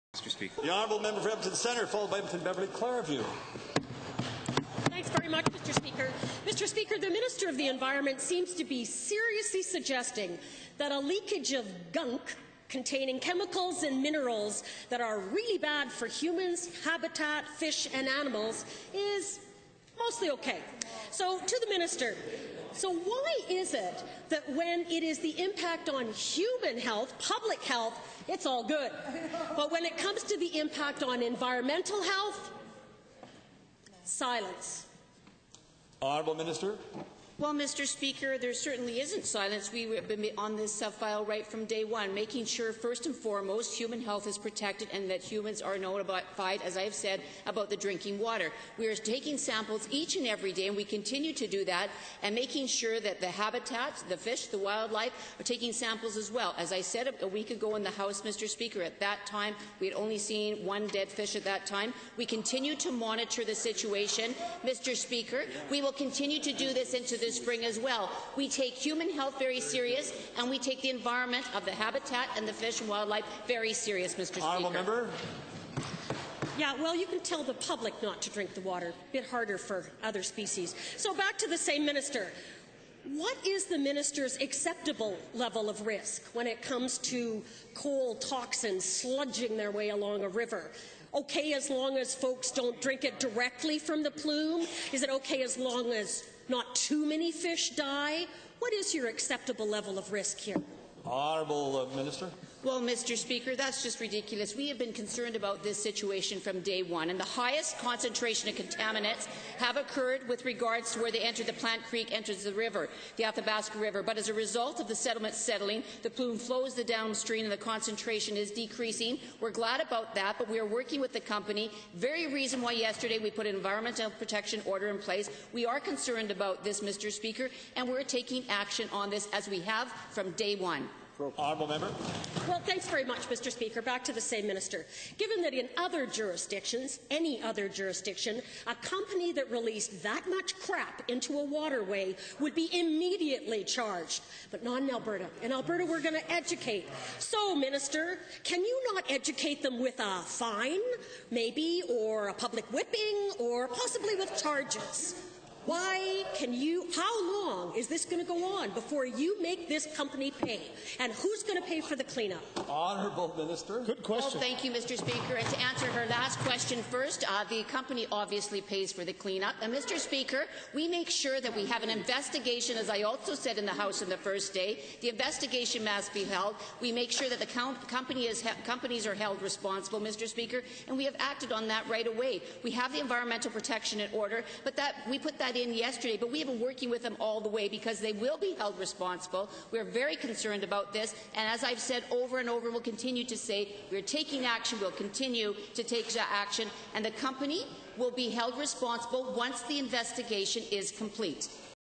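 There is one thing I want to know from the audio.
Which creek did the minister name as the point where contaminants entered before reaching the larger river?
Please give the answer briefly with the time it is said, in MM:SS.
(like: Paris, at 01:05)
Plante Creek, at 01:51.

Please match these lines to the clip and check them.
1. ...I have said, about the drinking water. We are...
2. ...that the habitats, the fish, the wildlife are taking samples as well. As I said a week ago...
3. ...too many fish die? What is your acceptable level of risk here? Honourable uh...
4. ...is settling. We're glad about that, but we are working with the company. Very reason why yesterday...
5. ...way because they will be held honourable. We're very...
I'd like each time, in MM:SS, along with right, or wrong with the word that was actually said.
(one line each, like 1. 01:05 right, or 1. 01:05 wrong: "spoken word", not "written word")
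1. 00:46 right
2. 00:52 right
3. 01:36 right
4. 01:58 wrong: "decreasing", not "settling"
5. 03:07 wrong: "responsible", not "honourable".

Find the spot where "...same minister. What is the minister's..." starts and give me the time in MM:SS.
01:21.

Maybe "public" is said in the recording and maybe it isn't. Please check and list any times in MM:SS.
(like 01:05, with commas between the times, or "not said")
00:27, 01:17, 02:32.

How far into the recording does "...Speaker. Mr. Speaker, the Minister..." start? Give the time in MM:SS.
00:05.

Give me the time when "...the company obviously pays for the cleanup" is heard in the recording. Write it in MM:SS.
02:47.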